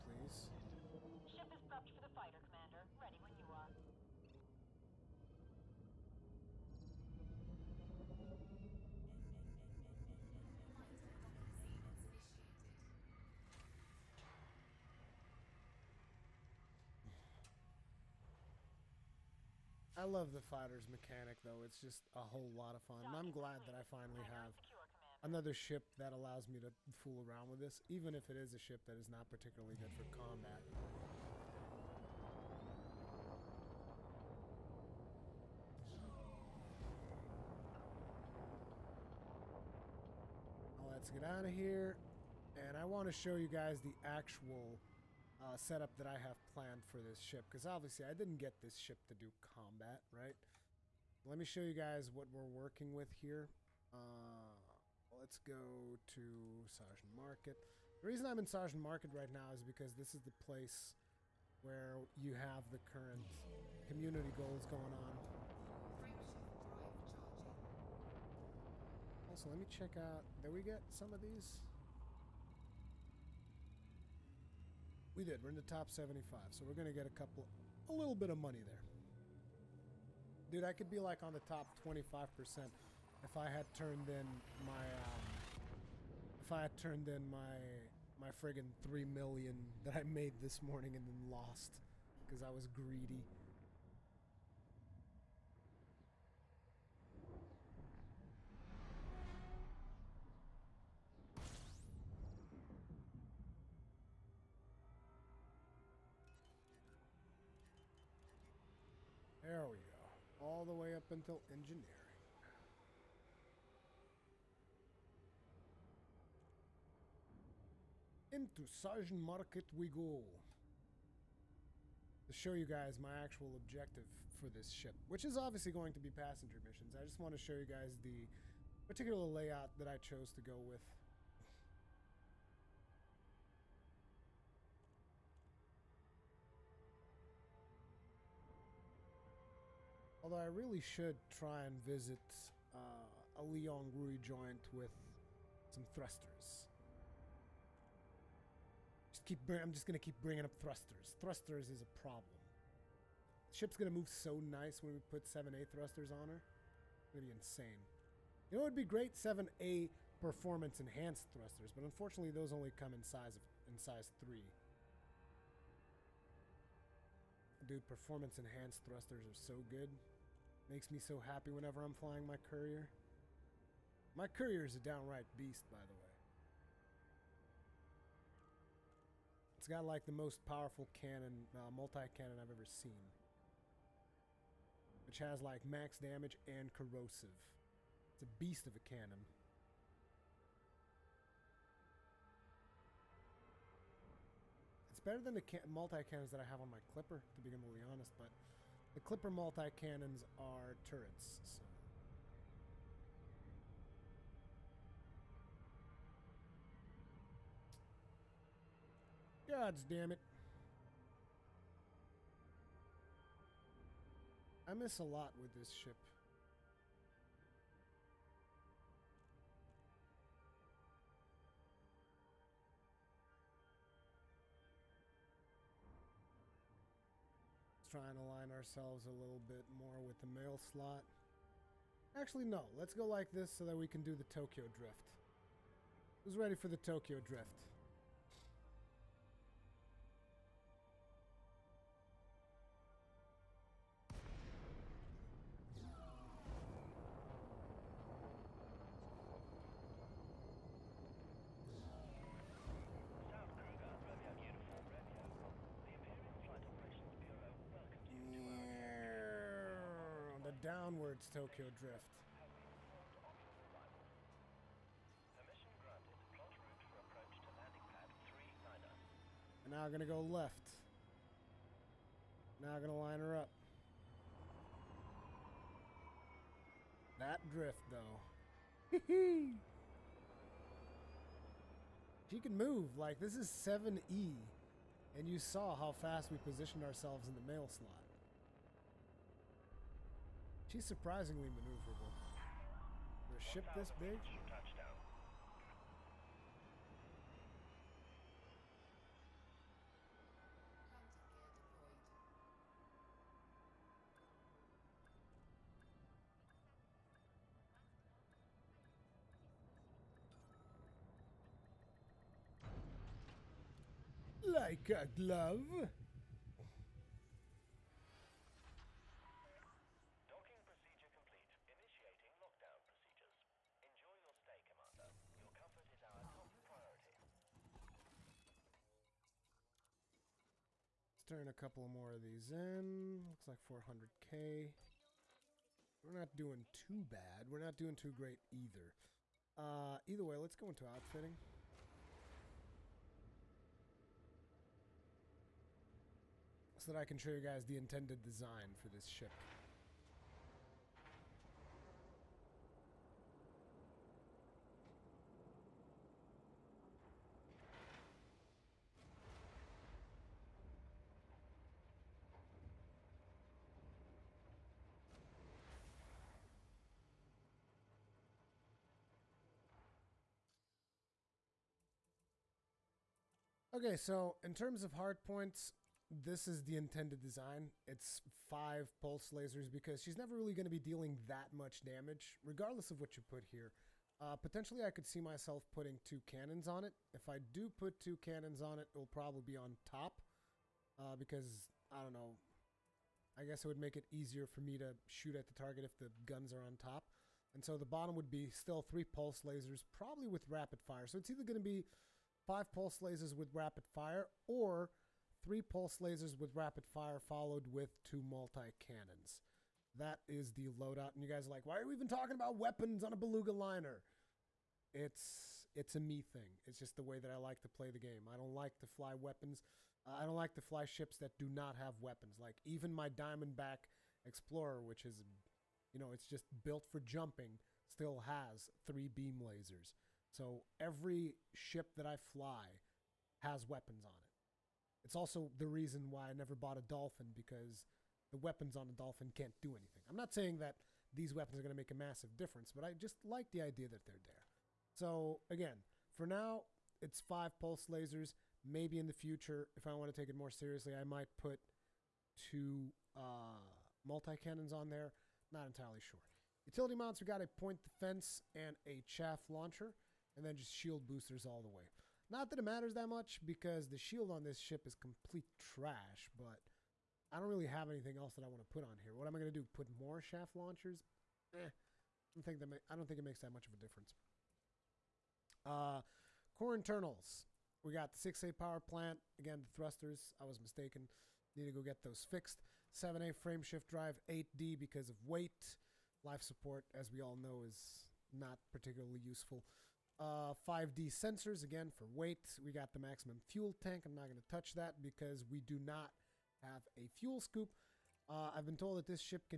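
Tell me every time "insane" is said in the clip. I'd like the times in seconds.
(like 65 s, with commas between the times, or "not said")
157 s.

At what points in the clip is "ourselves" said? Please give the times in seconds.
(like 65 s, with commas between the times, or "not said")
228 s, 286 s.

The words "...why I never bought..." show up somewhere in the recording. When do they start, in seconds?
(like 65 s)
436 s.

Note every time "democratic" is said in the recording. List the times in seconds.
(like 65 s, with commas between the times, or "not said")
not said.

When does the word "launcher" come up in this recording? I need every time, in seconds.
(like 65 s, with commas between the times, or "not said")
459 s, 470 s.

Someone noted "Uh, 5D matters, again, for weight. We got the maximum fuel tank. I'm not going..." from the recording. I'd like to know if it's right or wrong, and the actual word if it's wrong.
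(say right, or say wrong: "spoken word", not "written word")
wrong: "sensors", not "matters".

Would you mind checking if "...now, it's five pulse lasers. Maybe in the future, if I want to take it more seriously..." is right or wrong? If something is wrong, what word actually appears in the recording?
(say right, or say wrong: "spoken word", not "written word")
right.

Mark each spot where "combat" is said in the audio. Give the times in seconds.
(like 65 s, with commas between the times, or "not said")
30 s, 49 s.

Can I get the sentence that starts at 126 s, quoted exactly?
I just want to show you guys the particular layout that I chose to go with.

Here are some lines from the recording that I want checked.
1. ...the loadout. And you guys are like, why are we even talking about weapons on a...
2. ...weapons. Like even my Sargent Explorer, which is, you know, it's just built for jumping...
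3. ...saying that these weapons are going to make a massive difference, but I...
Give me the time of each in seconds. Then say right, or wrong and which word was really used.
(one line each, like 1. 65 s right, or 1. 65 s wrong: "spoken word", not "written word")
1. 410 s right
2. 421 s wrong: "Diamondback", not "Sargent"
3. 440 s right.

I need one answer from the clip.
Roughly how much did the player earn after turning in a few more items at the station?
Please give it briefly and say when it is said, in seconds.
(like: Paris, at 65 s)
400k, at 333 s.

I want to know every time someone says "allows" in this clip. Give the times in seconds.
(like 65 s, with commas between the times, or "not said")
26 s.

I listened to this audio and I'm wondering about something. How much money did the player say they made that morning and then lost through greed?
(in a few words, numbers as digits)
3 million.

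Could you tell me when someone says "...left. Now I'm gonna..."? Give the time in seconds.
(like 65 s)
270 s.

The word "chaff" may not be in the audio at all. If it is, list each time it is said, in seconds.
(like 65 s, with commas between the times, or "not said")
458 s, 470 s.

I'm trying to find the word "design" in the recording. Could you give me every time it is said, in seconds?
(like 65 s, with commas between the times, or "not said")
348 s, 377 s.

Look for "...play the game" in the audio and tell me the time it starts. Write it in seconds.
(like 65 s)
417 s.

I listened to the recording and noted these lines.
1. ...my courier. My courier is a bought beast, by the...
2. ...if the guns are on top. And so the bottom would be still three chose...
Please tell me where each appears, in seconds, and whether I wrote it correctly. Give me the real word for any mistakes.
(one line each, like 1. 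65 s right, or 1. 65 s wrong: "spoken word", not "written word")
1. 172 s wrong: "downright", not "bought"
2. 395 s wrong: "pulse", not "chose".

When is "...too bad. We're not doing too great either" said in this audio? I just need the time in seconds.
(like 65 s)
336 s.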